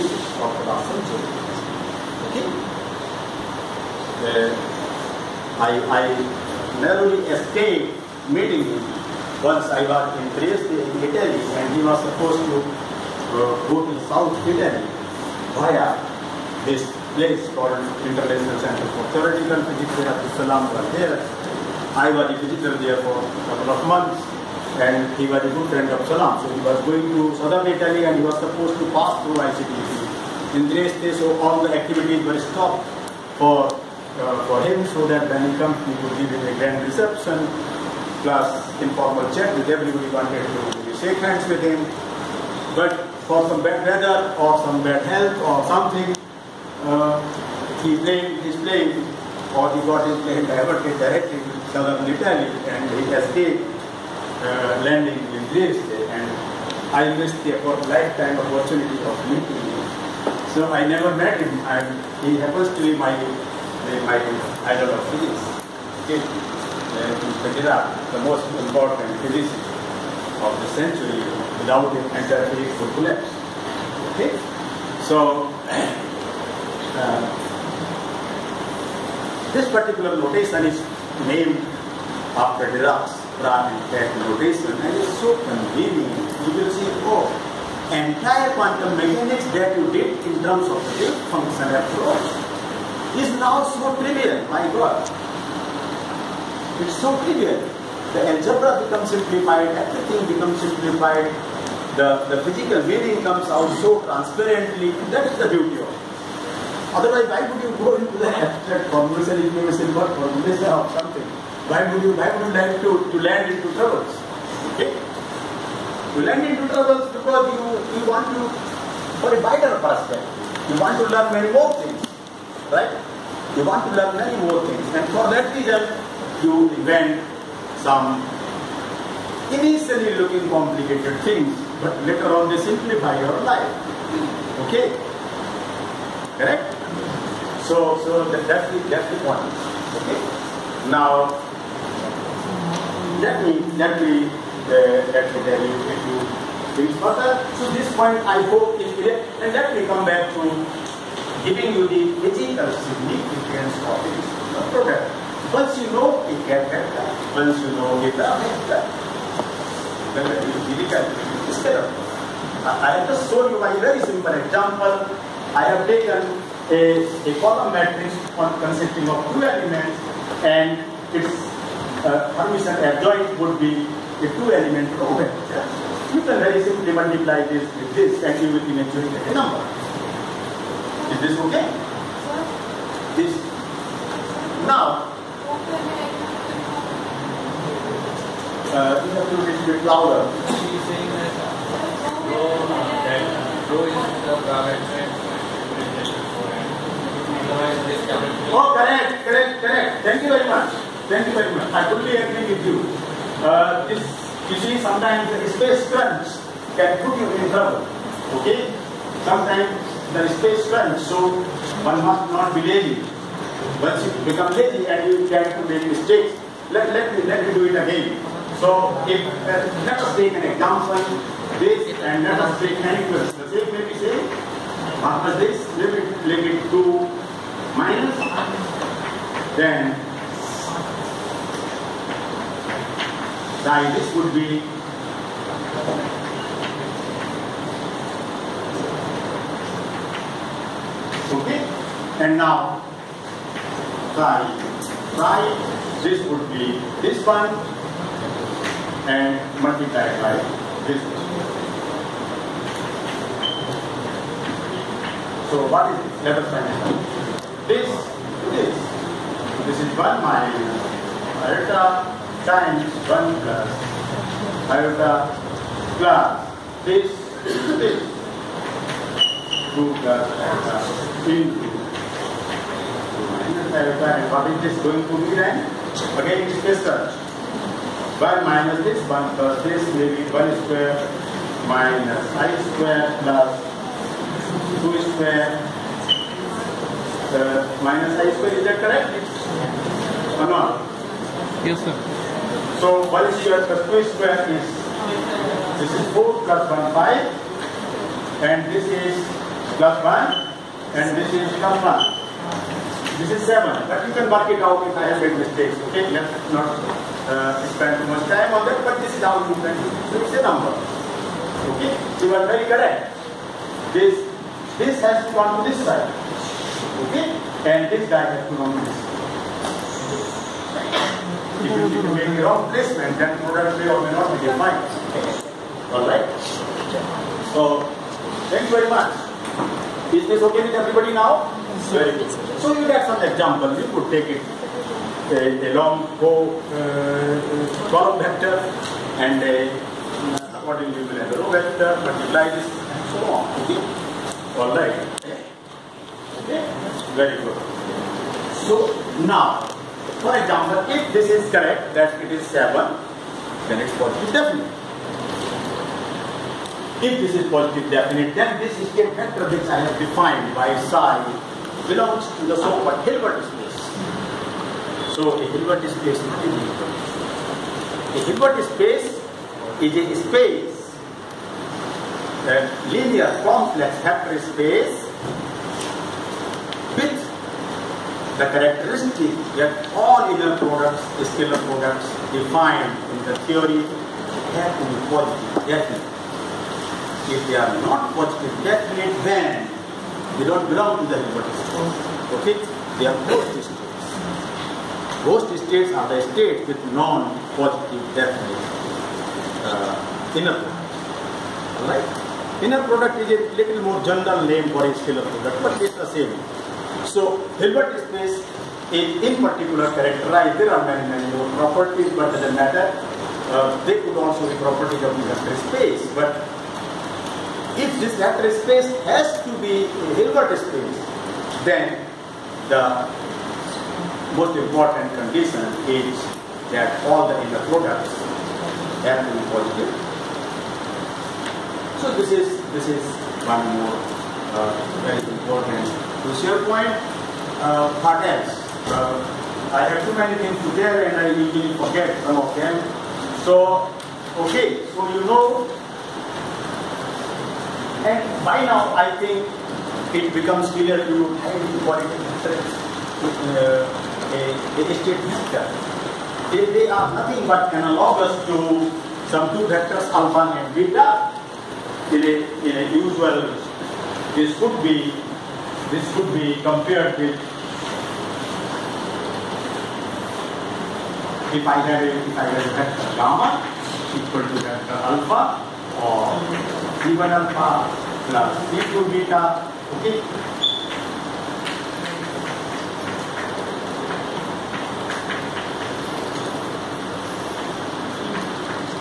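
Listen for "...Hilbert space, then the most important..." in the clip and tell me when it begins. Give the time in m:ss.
7:00.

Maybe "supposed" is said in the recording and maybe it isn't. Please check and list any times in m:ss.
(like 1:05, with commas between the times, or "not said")
0:12, 0:28.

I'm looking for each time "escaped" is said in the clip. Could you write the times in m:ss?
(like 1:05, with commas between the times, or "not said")
0:07, 0:53.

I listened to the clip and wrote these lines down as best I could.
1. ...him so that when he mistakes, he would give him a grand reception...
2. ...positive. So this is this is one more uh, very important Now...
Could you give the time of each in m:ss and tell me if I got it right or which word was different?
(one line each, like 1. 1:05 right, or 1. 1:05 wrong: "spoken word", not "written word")
1. 0:34 wrong: "comes", not "mistakes"
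2. 7:09 wrong: "Crucial", not "Now".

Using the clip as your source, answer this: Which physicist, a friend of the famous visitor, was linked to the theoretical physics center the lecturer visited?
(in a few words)
Abdul Salam.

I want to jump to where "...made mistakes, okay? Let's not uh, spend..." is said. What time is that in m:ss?
5:05.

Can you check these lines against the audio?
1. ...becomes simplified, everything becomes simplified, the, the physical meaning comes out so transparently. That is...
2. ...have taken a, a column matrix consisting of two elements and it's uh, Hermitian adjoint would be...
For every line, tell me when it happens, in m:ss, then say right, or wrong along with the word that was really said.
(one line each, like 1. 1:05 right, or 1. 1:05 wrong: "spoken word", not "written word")
1. 1:38 right
2. 2:45 right.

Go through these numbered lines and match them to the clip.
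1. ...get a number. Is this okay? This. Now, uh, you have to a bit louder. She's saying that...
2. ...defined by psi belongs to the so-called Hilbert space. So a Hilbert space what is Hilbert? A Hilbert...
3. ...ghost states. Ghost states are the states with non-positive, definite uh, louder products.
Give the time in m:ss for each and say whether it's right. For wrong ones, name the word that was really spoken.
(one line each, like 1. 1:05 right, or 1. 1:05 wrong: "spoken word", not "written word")
1. 2:59 right
2. 5:59 right
3. 6:33 wrong: "inner", not "louder".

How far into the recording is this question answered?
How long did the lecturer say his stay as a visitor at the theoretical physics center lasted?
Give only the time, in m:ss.
0:23.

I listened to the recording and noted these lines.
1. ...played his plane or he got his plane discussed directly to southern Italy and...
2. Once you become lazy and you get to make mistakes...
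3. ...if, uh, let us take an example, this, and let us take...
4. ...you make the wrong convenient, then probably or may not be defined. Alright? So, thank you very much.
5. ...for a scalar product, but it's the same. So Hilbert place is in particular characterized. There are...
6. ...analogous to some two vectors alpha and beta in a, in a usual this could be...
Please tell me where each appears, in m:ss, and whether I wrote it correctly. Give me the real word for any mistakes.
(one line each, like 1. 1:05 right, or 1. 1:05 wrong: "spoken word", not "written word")
1. 0:47 wrong: "diverted", not "discussed"
2. 3:33 right
3. 3:39 right
4. 5:21 wrong: "placement", not "convenient"
5. 6:44 wrong: "space", not "place"
6. 7:37 right.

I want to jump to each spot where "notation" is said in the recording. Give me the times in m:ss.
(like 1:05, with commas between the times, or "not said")
1:20, 1:24.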